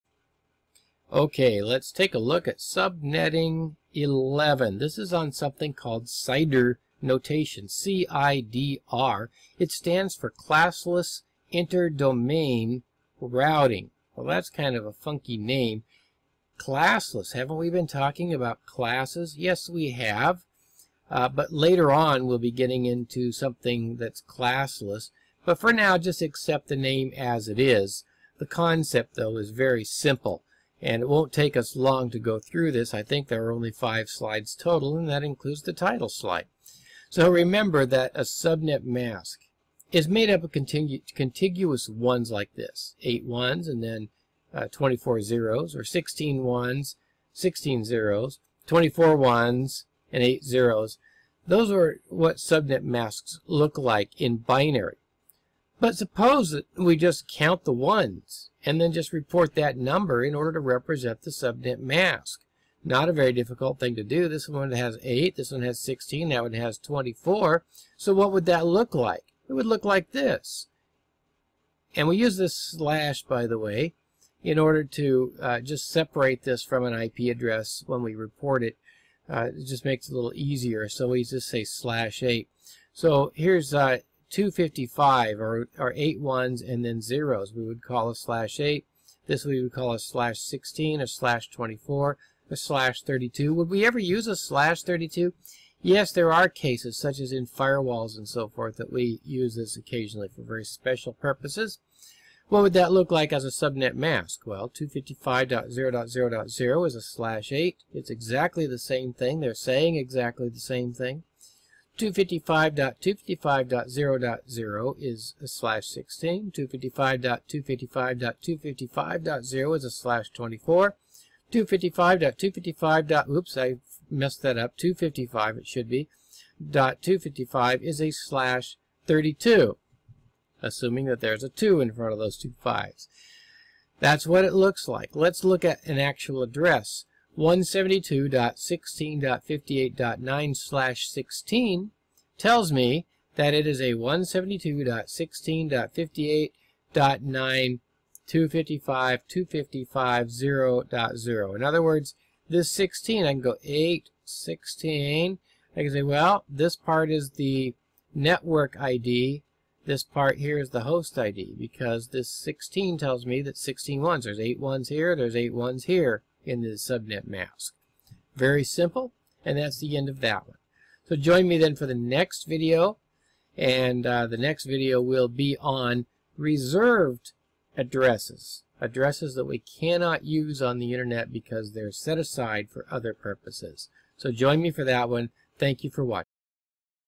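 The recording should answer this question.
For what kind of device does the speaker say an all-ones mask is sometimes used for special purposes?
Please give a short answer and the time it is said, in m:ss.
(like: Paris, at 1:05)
firewalls, at 1:37.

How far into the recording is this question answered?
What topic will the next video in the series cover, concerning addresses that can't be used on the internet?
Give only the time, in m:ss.
2:56.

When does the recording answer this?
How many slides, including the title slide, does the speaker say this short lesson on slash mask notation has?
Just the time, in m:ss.
0:33.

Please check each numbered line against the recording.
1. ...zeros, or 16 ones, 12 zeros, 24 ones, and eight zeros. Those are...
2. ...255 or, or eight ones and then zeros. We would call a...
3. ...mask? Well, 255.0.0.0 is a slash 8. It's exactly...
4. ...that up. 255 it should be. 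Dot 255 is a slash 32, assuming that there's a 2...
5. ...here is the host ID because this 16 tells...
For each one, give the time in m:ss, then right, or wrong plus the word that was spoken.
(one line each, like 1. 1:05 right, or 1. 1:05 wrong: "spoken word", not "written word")
1. 0:45 wrong: "16", not "12"
2. 1:24 right
3. 1:43 right
4. 2:04 right
5. 2:40 right.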